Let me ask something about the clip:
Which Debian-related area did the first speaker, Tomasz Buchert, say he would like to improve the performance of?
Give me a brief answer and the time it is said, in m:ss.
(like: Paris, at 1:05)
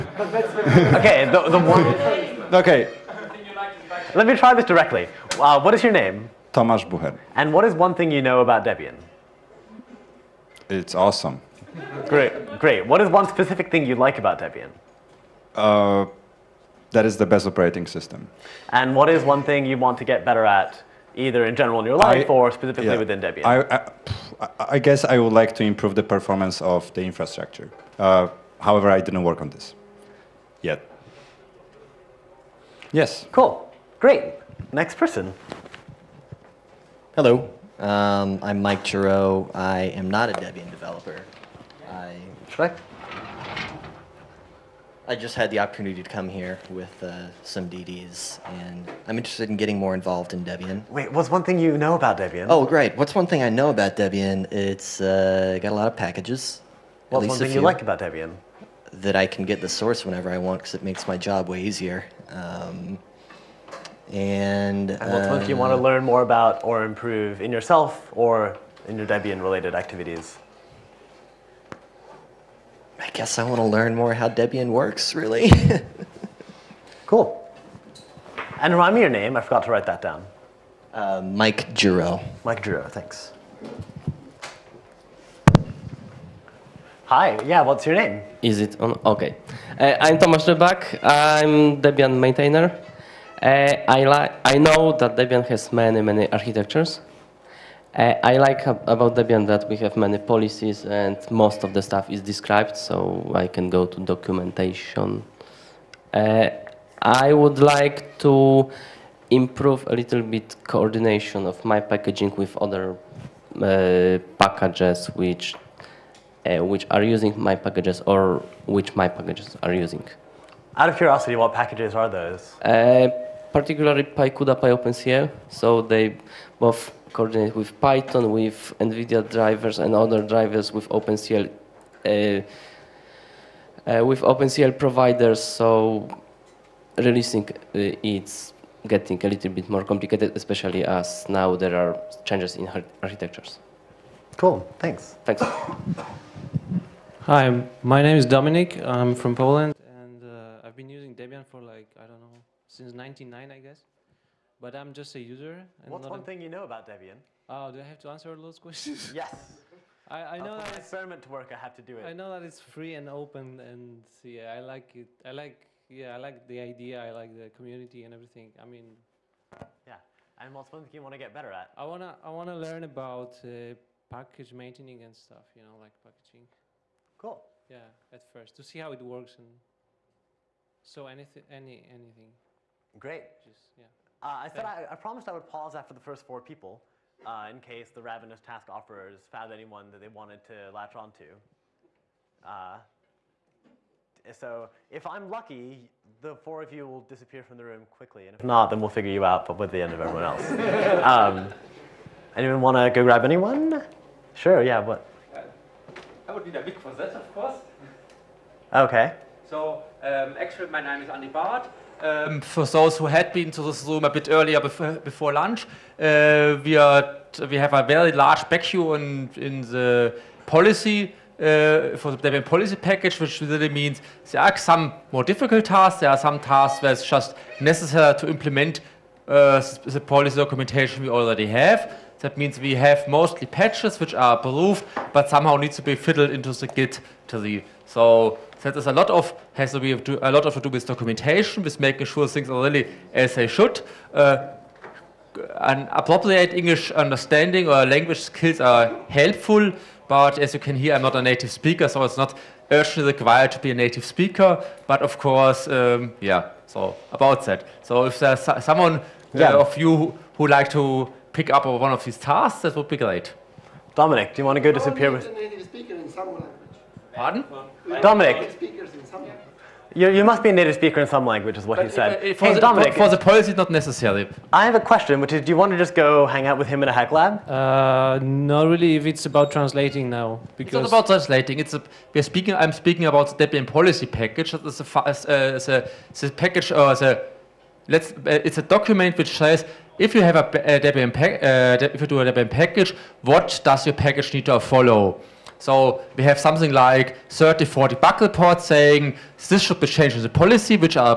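the infrastructure, at 0:26.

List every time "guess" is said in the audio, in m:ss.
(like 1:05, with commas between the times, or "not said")
0:24, 1:13, 2:33.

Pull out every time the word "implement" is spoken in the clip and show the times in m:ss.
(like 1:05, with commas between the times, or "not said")
3:48.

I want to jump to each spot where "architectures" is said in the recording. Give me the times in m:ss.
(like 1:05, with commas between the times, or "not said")
1:36, 2:23.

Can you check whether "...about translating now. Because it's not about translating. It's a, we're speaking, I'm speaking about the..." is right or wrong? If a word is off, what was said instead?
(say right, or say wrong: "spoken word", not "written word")
right.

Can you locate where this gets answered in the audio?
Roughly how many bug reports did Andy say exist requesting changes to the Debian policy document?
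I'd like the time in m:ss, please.
4:57.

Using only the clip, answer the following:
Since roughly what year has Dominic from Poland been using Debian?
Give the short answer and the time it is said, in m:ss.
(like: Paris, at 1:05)
1999, at 2:32.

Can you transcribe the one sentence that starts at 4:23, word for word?
Dominic, do you want to go disappear with?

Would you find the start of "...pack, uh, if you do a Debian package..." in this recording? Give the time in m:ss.
4:51.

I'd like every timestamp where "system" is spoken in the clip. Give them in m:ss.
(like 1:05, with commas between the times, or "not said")
0:17.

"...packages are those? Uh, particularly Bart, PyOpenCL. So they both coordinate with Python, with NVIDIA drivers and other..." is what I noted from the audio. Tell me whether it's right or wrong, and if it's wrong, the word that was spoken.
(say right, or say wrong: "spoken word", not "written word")
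wrong: "PyCuda", not "Bart".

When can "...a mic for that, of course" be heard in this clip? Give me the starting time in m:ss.
3:26.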